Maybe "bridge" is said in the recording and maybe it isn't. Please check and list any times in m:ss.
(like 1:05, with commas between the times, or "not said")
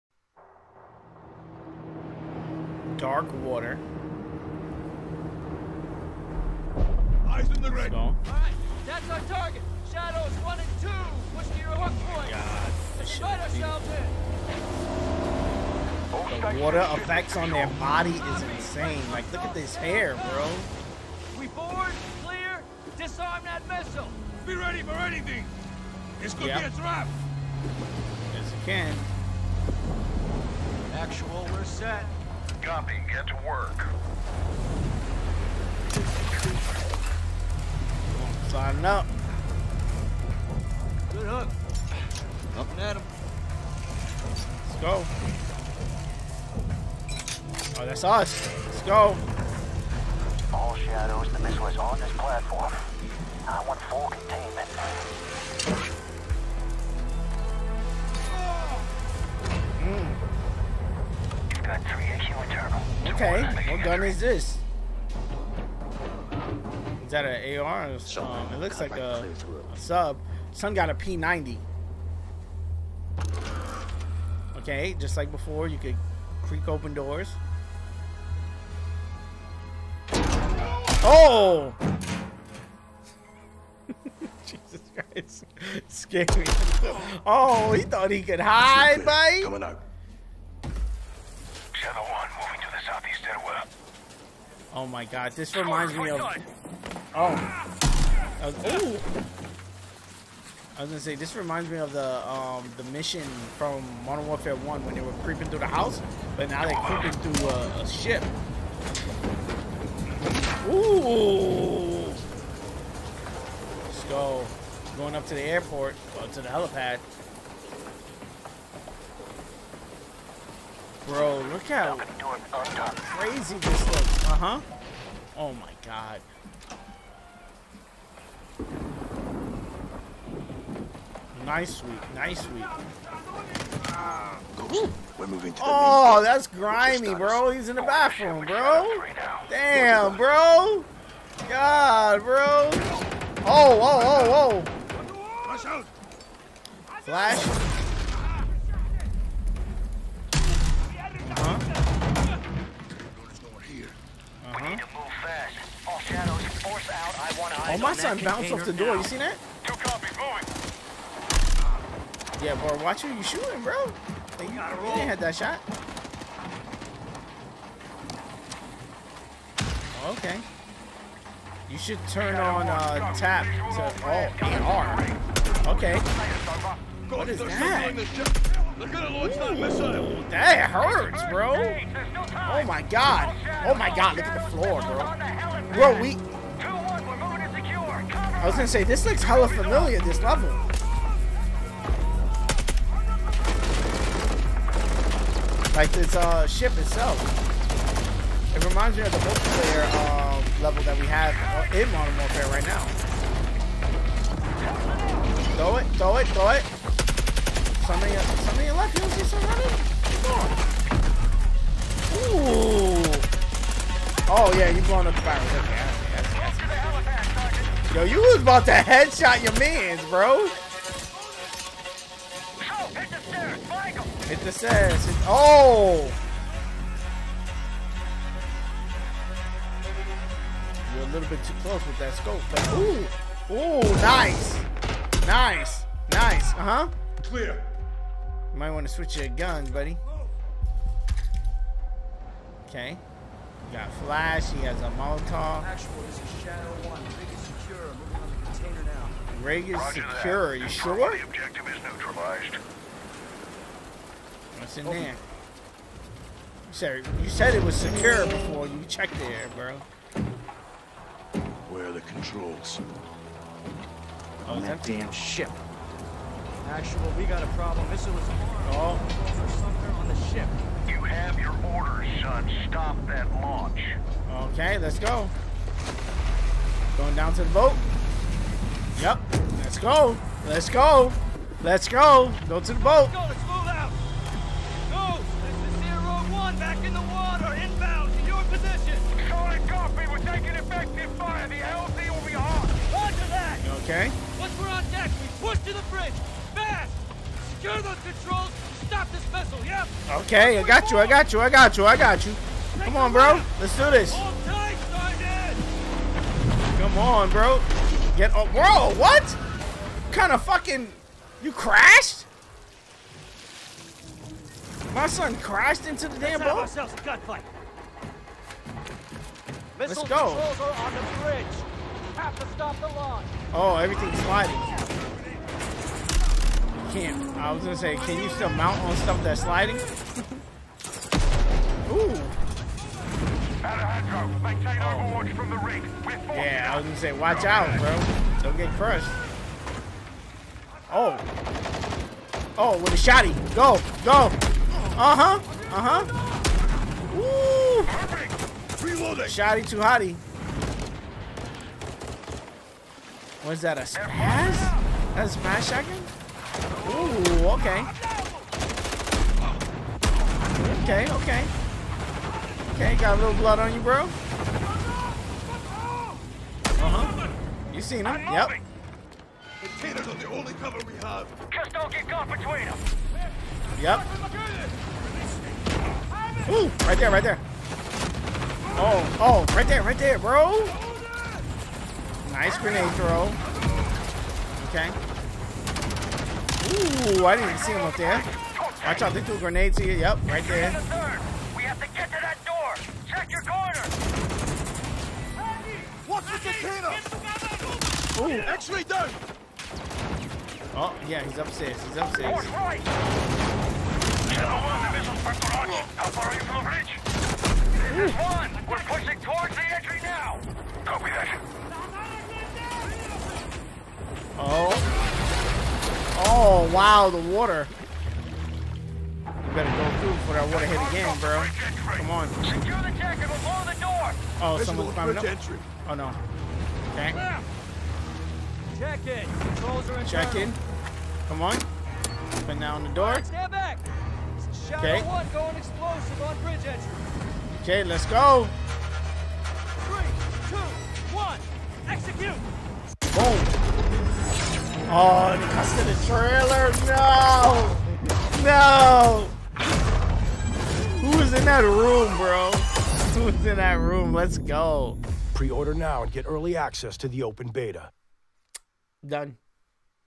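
4:55, 5:21, 7:16.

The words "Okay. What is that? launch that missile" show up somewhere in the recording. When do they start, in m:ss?
2:55.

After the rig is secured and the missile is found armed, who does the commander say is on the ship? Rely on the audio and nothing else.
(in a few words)
Sumner.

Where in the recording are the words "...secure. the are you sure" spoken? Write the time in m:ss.
4:09.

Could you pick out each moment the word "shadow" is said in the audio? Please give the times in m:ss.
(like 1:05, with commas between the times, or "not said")
0:09, 0:50, 4:06, 7:14.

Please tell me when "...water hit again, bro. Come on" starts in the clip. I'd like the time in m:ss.
7:00.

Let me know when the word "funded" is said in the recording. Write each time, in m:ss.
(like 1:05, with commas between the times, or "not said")
not said.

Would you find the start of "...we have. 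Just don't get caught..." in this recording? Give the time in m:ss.
6:10.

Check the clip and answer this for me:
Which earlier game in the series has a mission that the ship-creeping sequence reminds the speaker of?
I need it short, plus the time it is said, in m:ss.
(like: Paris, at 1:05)
Modern Warfare 1, at 1:44.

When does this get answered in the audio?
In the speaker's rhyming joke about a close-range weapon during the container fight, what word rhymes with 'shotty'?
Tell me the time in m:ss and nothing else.
5:49.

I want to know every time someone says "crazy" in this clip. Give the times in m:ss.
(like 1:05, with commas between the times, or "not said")
2:01.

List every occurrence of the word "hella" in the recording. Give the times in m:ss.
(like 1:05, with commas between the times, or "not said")
3:09.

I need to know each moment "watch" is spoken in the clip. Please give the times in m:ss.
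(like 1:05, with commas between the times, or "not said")
2:42, 5:37, 6:28.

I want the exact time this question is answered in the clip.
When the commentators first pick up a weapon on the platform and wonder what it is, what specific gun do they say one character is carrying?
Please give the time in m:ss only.
1:10.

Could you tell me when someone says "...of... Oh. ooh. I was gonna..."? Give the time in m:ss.
1:36.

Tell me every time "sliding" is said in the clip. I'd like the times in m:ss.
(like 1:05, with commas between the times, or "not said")
5:24, 5:29.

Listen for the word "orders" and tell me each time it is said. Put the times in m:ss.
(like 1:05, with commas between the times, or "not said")
4:31, 7:35.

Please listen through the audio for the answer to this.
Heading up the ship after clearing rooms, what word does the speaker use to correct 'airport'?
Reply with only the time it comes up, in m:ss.
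1:56.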